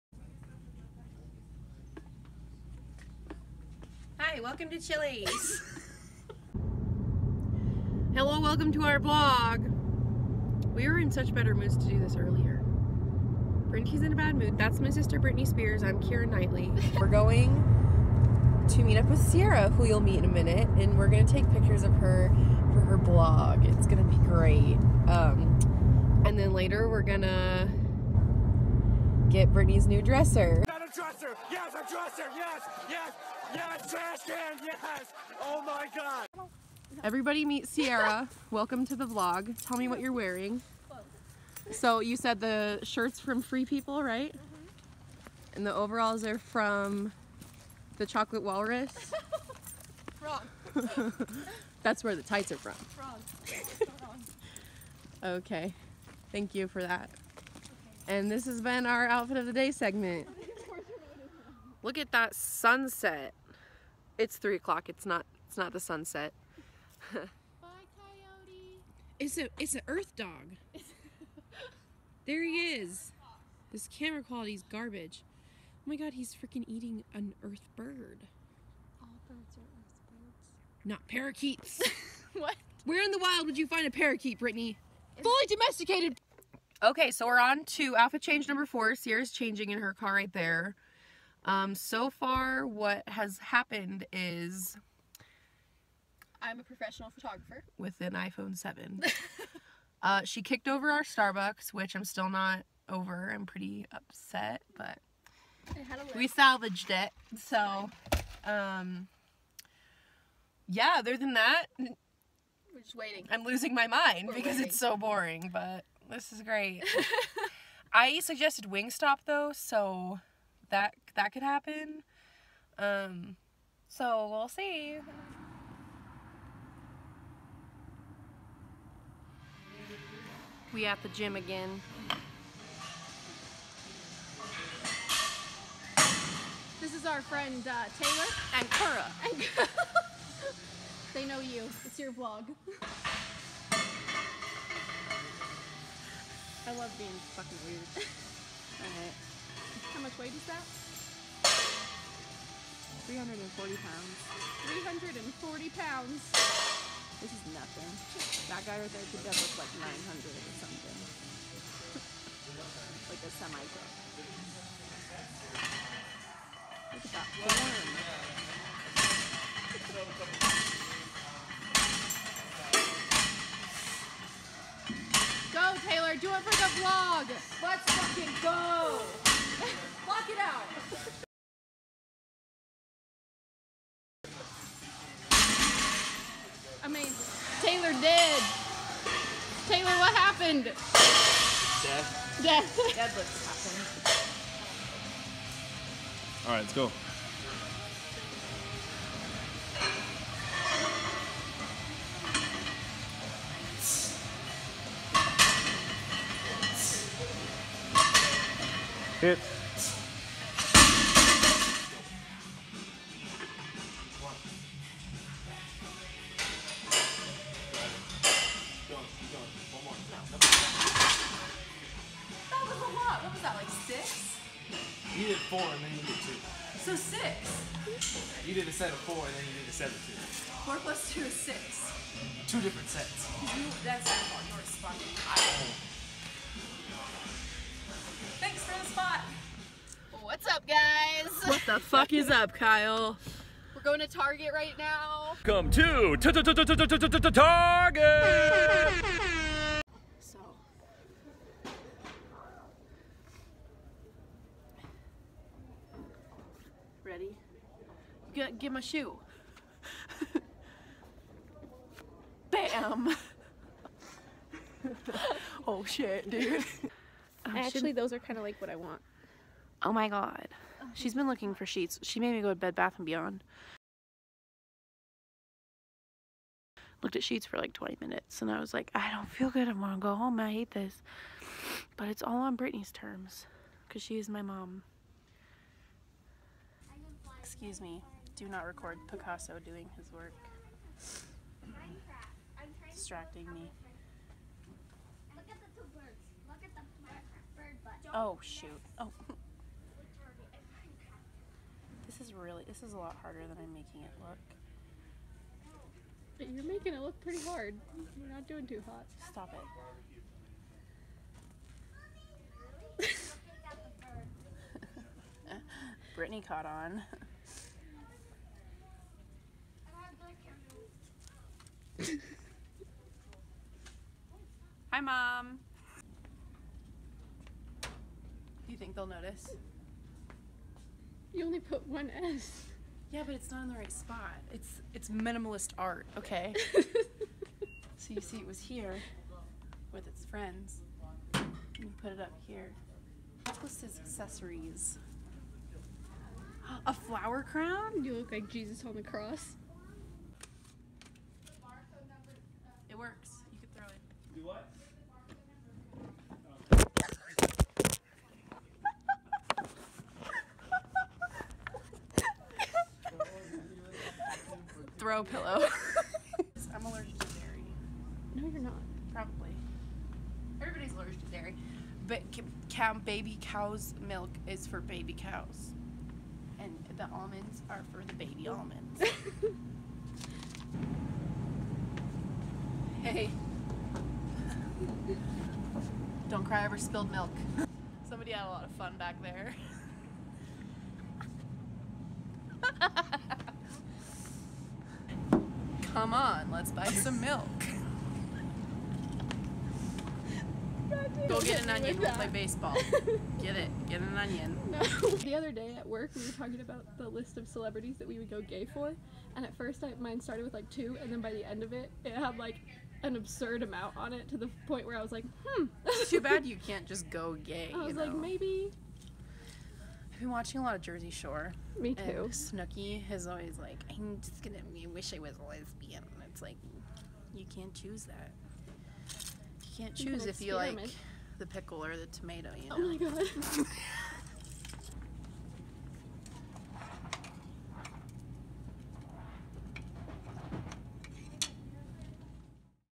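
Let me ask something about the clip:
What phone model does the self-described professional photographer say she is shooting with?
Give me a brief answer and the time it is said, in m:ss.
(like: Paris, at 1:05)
iPhone 7, at 1:38.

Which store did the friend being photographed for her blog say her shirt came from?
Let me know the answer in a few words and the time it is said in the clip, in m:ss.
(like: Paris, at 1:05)
Free People, at 0:43.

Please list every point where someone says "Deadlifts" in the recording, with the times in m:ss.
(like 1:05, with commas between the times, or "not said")
3:12.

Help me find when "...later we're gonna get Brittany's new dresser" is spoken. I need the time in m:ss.
0:26.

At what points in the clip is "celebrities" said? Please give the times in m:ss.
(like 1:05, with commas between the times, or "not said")
6:47.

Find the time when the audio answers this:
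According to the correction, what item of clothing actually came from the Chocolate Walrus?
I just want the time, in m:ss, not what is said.
0:52.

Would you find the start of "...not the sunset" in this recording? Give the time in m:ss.
1:05.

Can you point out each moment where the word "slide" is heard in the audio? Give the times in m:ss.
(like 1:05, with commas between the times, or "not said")
not said.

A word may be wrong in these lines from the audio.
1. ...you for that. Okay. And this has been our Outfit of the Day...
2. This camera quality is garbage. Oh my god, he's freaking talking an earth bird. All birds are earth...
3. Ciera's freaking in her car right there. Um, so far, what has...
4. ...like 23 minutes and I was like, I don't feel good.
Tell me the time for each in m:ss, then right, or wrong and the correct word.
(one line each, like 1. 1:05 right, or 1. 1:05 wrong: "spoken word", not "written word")
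1. 0:56 right
2. 1:13 wrong: "eating", not "talking"
3. 1:28 wrong: "changing", not "freaking"
4. 4:37 wrong: "20", not "23".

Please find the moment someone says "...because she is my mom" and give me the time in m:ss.
4:43.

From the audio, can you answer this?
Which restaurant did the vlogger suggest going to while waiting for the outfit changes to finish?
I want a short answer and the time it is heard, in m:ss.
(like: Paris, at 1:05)
Wingstop, at 1:58.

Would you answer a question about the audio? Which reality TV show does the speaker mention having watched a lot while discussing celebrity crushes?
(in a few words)
Jersey Shore.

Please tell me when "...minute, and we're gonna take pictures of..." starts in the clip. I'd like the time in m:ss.
0:20.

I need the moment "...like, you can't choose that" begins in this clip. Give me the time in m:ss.
7:06.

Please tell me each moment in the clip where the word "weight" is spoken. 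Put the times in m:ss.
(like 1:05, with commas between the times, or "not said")
2:30.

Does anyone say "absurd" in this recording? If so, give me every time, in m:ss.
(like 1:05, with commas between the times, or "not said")
6:53.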